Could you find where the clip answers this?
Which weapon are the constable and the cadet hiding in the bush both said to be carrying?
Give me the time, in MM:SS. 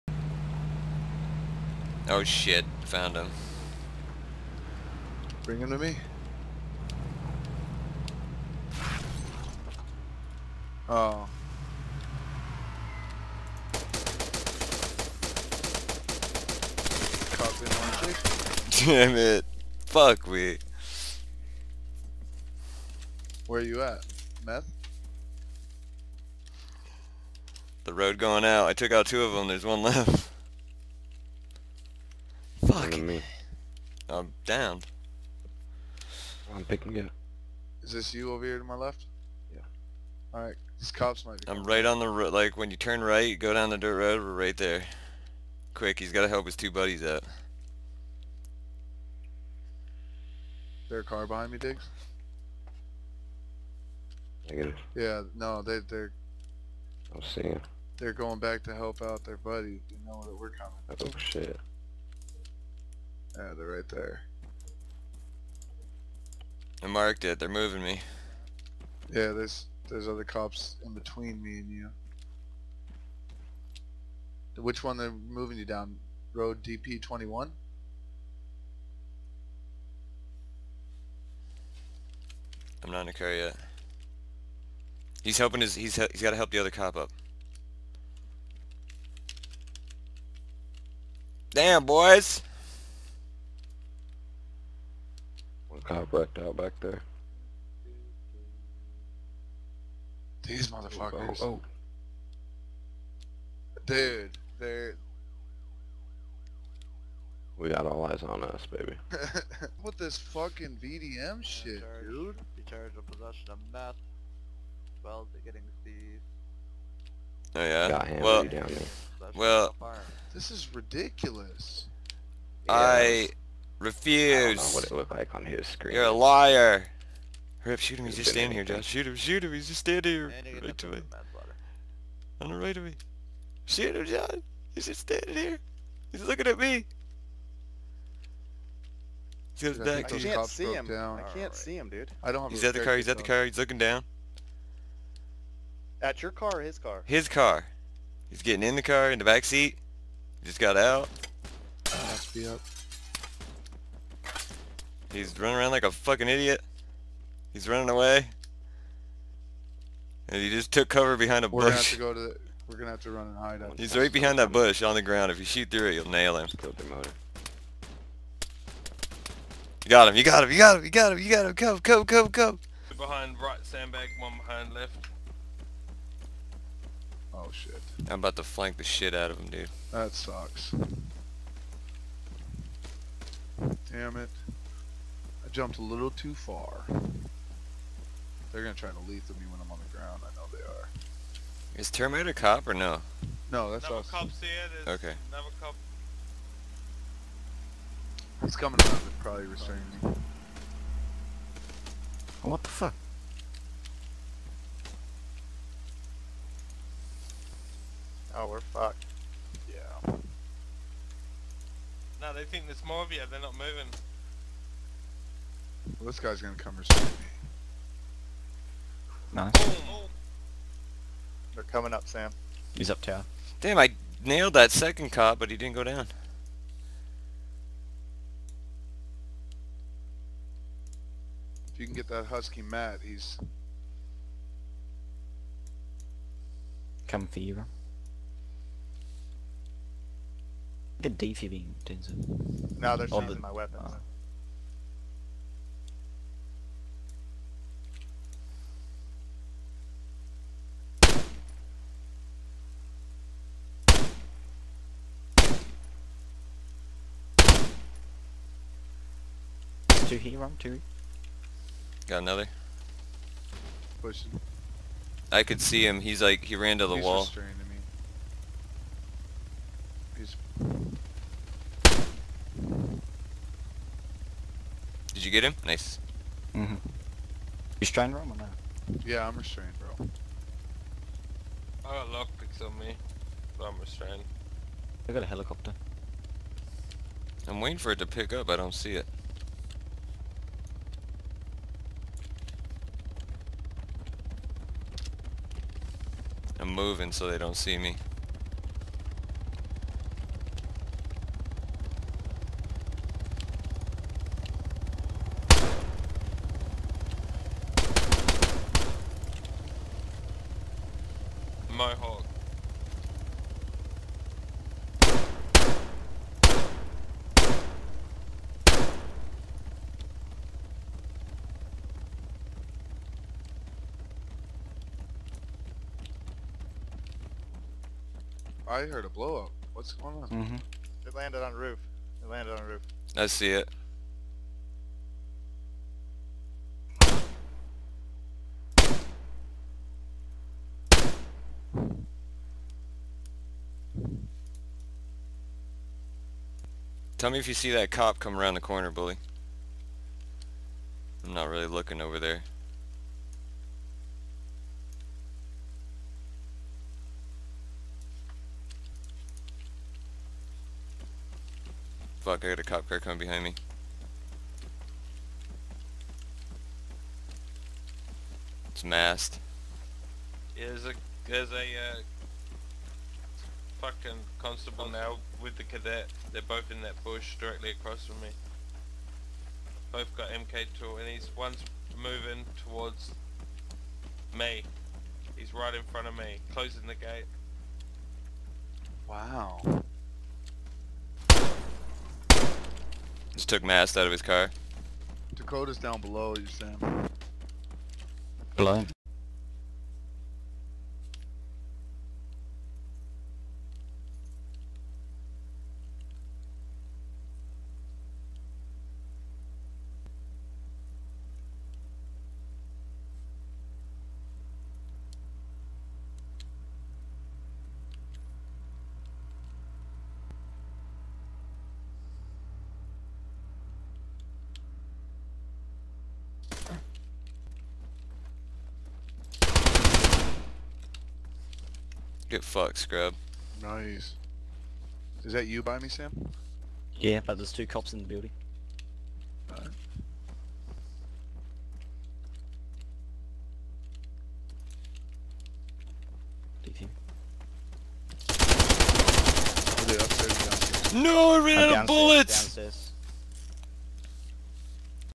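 06:19.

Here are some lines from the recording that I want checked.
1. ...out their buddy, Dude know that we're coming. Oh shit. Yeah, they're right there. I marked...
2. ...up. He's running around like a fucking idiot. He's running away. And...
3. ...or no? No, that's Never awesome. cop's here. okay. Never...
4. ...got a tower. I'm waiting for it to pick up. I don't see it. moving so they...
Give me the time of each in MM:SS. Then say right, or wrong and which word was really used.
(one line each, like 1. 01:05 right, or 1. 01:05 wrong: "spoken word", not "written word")
1. 00:59 wrong: "You", not "Dude"
2. 02:32 right
3. 03:12 right
4. 04:45 wrong: "helicopter", not "tower".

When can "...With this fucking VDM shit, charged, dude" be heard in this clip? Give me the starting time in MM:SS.
01:49.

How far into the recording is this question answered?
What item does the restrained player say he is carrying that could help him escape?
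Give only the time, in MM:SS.
04:41.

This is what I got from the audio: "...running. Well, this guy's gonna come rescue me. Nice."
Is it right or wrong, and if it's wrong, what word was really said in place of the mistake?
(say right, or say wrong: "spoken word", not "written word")
wrong: "moving", not "running".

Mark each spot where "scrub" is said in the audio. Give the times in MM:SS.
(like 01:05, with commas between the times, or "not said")
07:12.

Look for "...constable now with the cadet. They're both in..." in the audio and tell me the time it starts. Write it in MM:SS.
06:14.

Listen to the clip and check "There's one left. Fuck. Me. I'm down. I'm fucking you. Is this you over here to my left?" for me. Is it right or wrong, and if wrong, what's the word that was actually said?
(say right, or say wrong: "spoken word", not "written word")
wrong: "picking", not "fucking".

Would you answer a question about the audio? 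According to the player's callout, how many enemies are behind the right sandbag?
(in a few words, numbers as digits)
2.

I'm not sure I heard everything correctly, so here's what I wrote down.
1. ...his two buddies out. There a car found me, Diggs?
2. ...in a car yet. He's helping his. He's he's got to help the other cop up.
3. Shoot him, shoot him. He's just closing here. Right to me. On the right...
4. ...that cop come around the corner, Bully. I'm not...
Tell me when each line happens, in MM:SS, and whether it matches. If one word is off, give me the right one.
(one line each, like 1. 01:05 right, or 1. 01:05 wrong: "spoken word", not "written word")
1. 00:46 wrong: "behind", not "found"
2. 01:23 right
3. 02:08 wrong: "standing", not "closing"
4. 05:47 right.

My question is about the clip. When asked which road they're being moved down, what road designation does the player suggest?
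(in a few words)
DP 21.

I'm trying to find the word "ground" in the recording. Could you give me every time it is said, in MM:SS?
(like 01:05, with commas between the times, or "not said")
02:45, 03:09.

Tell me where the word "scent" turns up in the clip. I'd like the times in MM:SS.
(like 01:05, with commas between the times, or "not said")
not said.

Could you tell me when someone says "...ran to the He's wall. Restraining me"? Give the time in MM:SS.
04:26.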